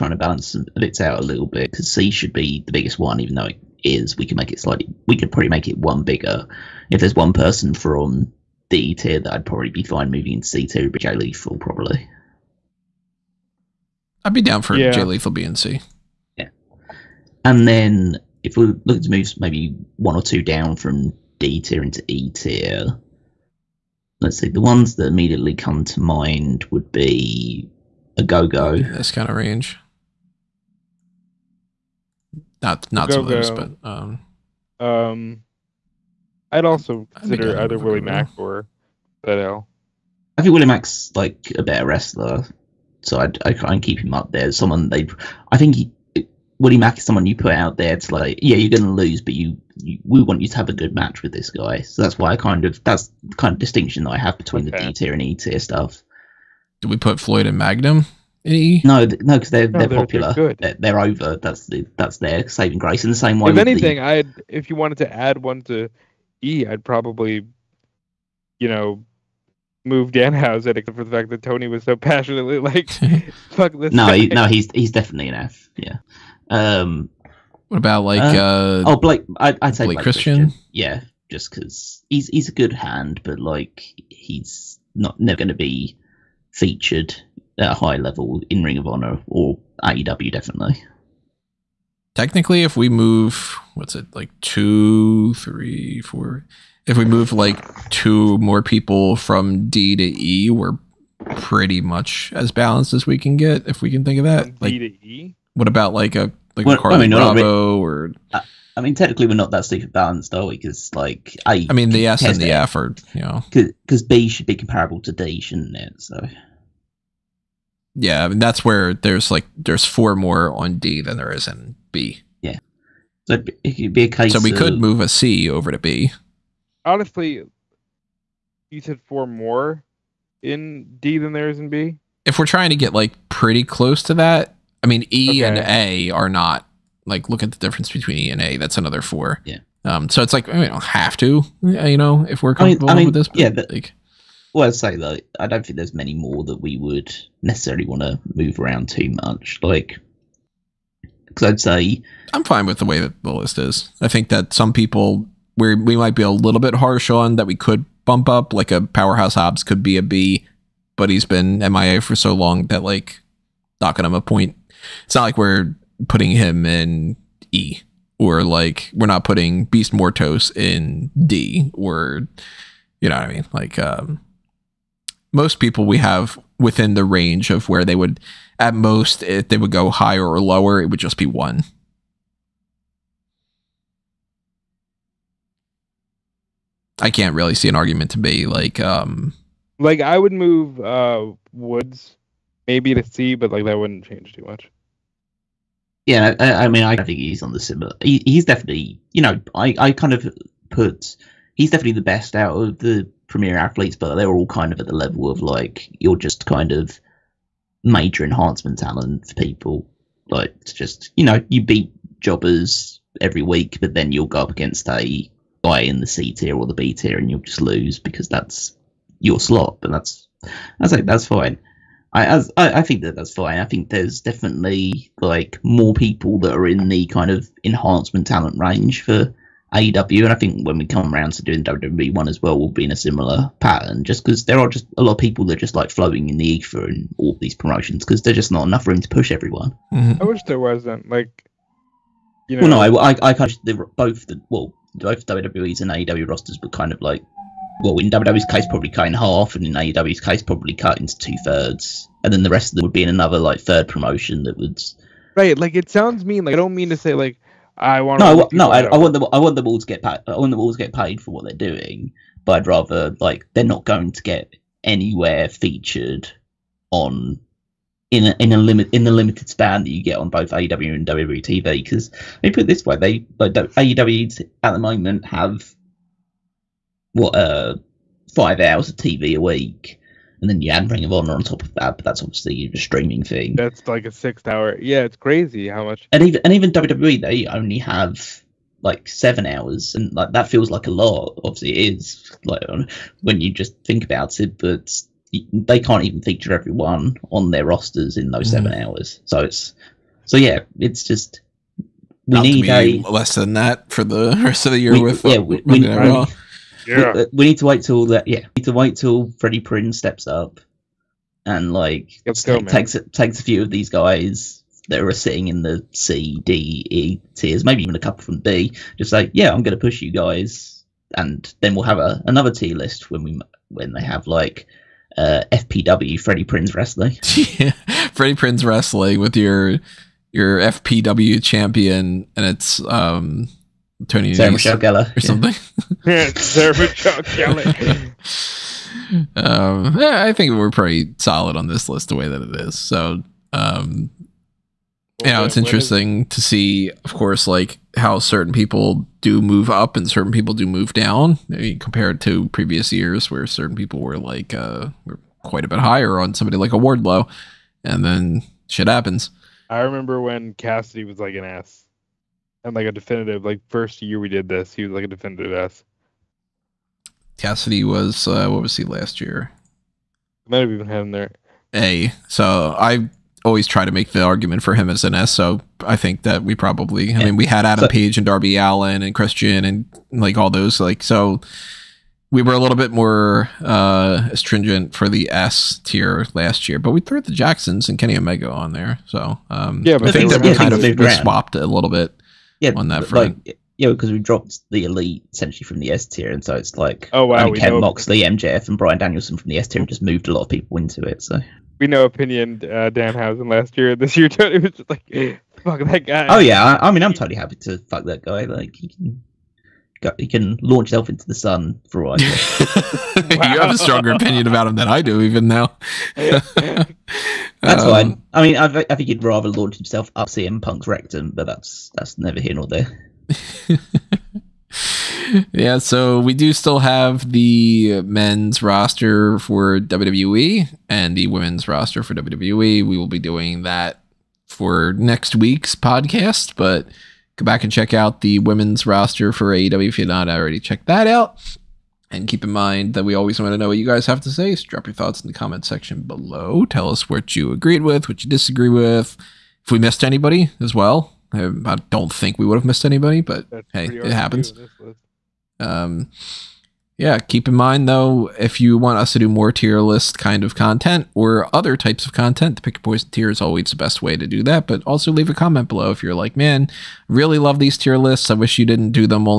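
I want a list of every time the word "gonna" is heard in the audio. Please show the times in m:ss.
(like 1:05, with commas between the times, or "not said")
0:48.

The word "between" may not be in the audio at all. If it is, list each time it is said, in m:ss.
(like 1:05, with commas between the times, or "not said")
0:54, 2:17.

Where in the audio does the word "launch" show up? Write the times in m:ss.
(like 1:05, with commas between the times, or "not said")
6:50, 6:59.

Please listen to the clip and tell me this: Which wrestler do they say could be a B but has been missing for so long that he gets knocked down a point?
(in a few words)
Powerhouse Hobbs.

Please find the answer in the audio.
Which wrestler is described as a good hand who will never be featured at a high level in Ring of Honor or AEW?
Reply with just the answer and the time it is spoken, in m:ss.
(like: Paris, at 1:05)
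Blake Christian, at 1:19.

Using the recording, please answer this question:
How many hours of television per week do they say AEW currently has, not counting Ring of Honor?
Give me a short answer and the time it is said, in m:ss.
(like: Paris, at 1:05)
5, at 4:38.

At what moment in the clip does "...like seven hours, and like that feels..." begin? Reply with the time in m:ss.
4:48.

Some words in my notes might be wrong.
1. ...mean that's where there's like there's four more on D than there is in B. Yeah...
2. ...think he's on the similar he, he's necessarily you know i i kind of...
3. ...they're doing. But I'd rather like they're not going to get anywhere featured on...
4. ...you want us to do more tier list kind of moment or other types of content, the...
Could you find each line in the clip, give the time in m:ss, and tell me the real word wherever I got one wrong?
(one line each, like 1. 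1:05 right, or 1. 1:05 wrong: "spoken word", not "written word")
1. 1:58 right
2. 3:16 wrong: "definitely", not "necessarily"
3. 4:21 right
4. 7:38 wrong: "content", not "moment".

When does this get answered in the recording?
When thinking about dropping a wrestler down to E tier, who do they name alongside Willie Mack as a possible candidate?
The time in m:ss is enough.
0:39.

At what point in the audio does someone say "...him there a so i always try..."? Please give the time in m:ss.
6:11.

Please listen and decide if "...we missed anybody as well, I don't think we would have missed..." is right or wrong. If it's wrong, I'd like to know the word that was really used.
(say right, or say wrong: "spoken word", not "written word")
right.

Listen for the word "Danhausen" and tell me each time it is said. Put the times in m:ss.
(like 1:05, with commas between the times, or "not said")
1:10, 6:42.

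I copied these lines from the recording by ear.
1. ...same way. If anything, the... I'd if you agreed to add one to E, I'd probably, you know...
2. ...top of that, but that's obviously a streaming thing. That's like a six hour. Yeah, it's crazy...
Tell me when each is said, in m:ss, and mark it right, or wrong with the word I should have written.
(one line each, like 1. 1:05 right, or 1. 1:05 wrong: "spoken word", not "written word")
1. 1:03 wrong: "wanted", not "agreed"
2. 4:41 right.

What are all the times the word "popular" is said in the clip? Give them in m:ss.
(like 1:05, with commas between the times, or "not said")
0:59.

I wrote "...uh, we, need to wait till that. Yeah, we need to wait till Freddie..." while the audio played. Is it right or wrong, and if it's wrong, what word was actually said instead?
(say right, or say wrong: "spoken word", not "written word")
right.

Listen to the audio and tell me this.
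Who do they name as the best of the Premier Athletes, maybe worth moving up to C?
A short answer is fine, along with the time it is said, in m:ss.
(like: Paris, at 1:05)
Woods, at 3:11.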